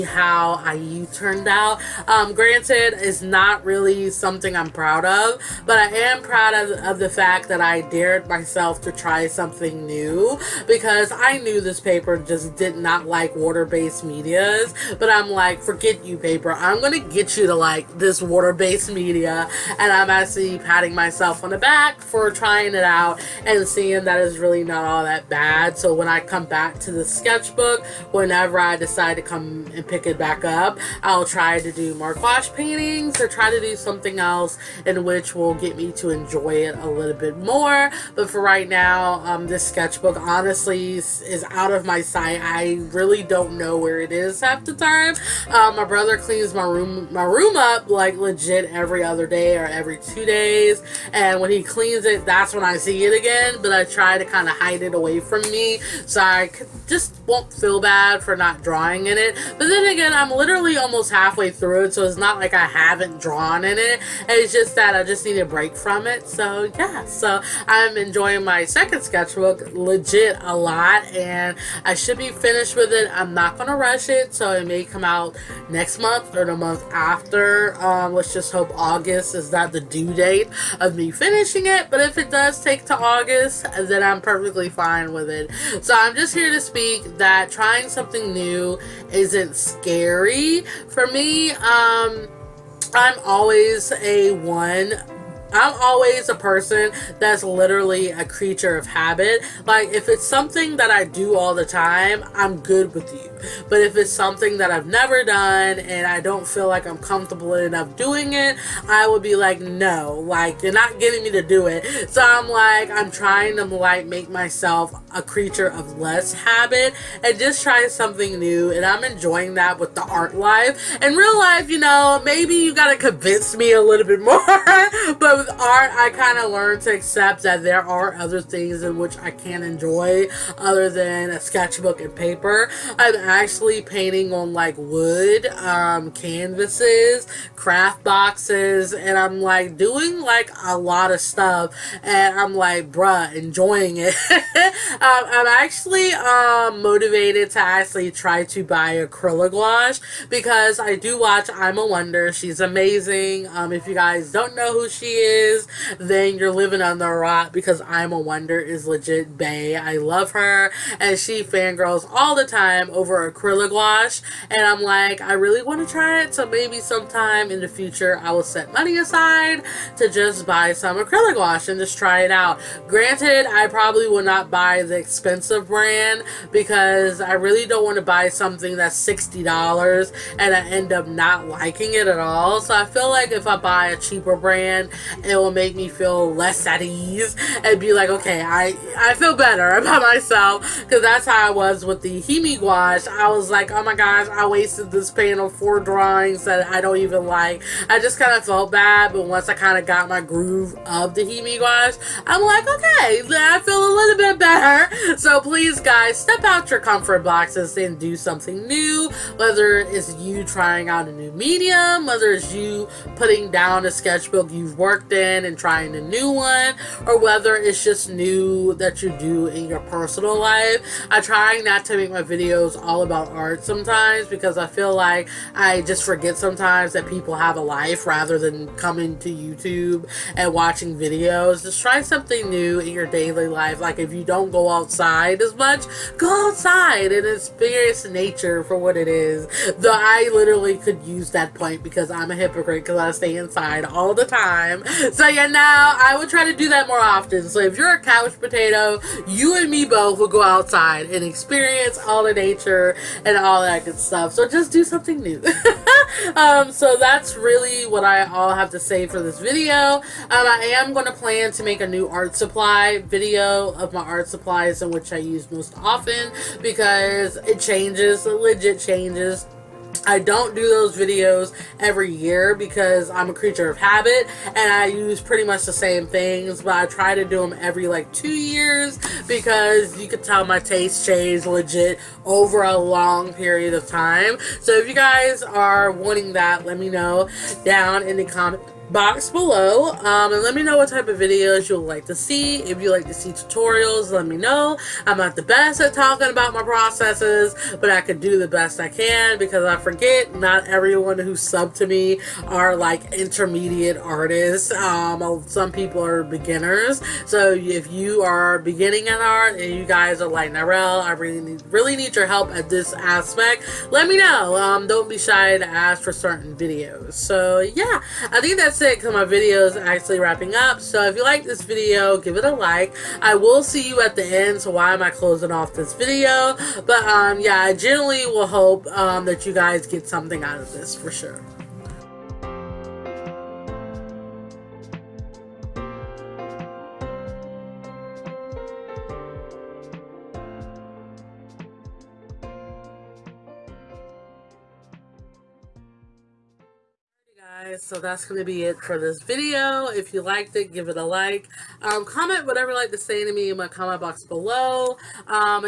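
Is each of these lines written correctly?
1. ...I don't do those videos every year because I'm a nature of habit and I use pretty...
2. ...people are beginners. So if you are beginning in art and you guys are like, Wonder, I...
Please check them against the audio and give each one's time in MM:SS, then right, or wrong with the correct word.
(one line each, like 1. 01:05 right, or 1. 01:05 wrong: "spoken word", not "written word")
1. 04:30 wrong: "creature", not "nature"
2. 05:05 wrong: "Nyrelle", not "Wonder".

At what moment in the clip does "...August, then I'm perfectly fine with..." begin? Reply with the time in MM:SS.
01:22.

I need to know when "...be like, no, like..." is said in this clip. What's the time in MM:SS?
01:49.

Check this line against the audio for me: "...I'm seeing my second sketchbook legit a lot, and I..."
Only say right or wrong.
wrong.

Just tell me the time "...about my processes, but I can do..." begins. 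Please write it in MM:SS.
04:56.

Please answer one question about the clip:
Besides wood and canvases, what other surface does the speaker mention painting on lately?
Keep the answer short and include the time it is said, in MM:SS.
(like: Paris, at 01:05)
craft boxes, at 02:17.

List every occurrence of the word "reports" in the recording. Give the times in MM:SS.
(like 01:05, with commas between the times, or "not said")
not said.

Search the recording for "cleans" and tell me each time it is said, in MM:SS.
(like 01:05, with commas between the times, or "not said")
00:46, 00:51.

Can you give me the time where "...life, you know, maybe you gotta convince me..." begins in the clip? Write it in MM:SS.
02:01.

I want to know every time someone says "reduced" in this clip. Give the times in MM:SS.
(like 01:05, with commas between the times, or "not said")
not said.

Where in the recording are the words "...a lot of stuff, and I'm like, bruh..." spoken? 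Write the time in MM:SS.
02:20.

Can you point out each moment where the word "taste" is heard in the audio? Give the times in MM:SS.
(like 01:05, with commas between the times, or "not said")
04:40.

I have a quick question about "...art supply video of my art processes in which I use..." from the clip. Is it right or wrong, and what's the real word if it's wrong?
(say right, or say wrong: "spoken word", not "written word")
wrong: "supplies", not "processes".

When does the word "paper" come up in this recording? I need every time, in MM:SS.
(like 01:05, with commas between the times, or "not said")
00:11, 00:16, 02:12.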